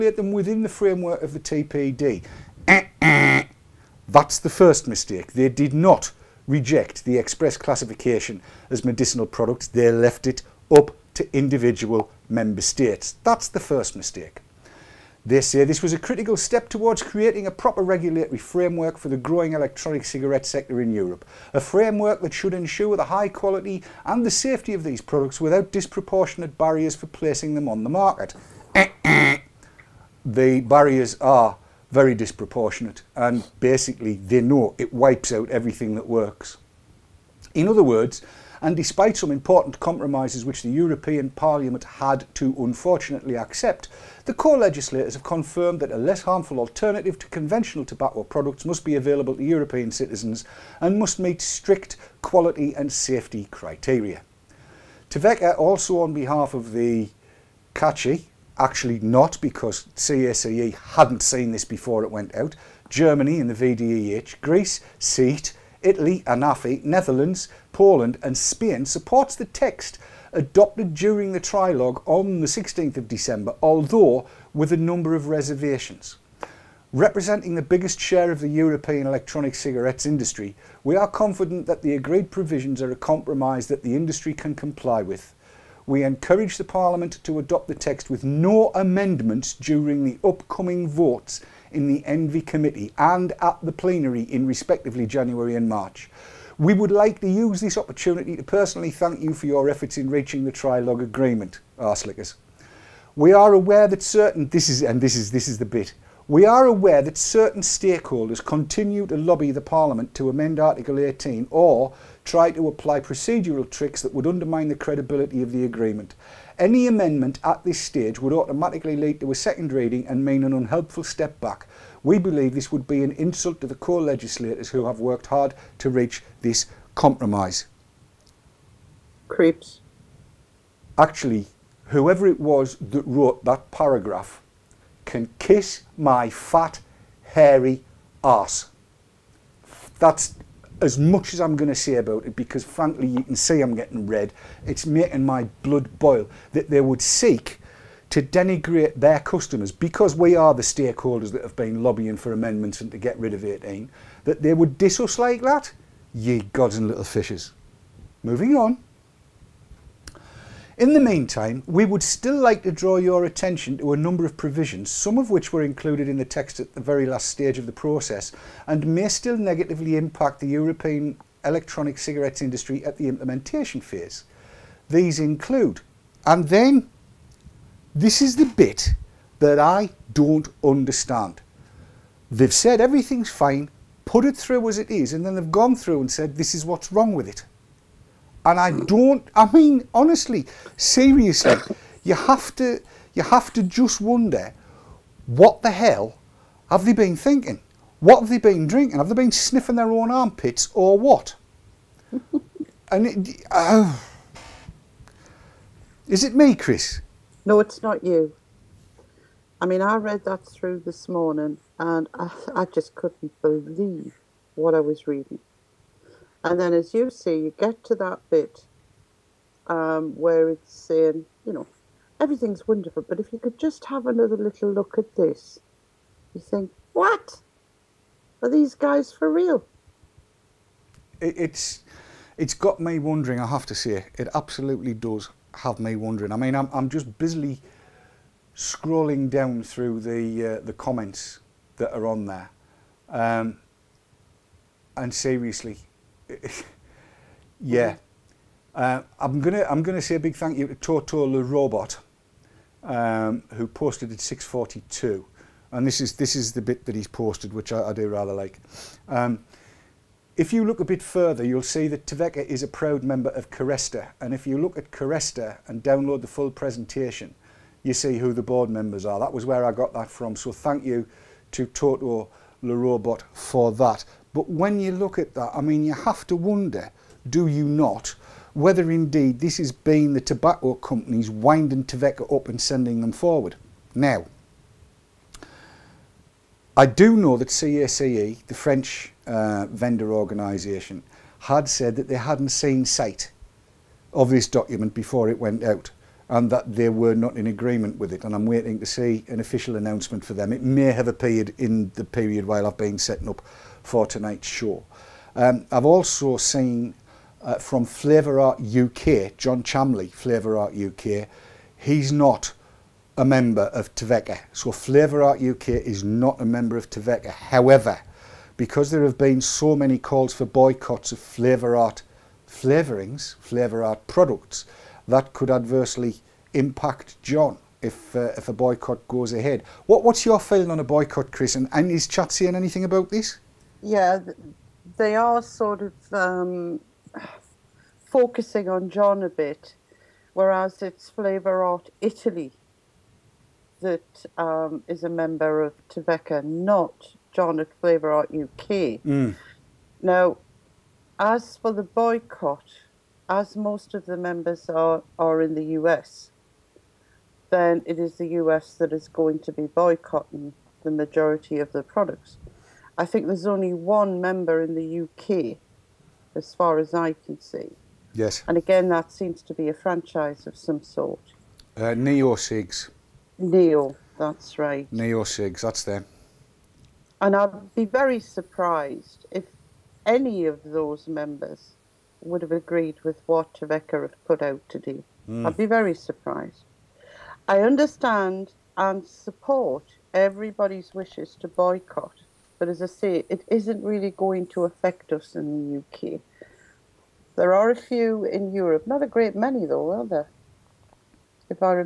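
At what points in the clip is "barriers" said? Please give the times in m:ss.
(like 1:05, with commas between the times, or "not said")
0:26, 0:30.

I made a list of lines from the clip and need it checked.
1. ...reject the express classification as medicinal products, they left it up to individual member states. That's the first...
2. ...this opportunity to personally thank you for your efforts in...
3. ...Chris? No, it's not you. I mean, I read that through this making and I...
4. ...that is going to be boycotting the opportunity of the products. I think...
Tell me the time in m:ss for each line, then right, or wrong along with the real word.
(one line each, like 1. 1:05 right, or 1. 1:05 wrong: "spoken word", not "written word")
1. 0:06 right
2. 1:37 right
3. 3:26 wrong: "morning", not "making"
4. 5:58 wrong: "majority", not "opportunity".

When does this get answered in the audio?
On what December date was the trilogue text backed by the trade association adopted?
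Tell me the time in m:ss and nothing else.
1:12.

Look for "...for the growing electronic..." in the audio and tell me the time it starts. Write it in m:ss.
0:18.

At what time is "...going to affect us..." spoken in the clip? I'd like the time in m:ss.
6:34.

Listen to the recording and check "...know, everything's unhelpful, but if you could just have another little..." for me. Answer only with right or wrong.
wrong.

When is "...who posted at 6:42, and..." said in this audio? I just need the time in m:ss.
4:13.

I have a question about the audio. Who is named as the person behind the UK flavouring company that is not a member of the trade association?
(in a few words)
John Chamley.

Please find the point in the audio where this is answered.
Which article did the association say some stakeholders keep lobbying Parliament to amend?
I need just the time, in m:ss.
1:50.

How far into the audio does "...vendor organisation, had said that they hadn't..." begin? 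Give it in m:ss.
4:49.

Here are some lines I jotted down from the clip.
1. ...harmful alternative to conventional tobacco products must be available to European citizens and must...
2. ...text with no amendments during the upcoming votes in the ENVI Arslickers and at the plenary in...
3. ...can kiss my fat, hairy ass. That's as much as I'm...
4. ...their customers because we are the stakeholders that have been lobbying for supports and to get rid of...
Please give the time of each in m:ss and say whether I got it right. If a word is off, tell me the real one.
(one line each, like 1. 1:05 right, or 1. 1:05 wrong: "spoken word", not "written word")
1. 0:46 right
2. 1:27 wrong: "Committee", not "Arslickers"
3. 2:15 right
4. 2:28 wrong: "amendments", not "supports".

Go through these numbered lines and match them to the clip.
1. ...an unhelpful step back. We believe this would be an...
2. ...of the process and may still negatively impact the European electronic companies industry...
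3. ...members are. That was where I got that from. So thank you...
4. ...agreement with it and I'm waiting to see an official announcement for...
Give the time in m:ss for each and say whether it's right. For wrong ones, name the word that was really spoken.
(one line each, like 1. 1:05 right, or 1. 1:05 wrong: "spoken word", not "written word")
1. 2:00 right
2. 2:47 wrong: "cigarettes", not "companies"
3. 4:28 right
4. 4:57 right.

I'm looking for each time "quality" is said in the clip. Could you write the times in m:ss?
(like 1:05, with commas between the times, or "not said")
0:23, 0:52.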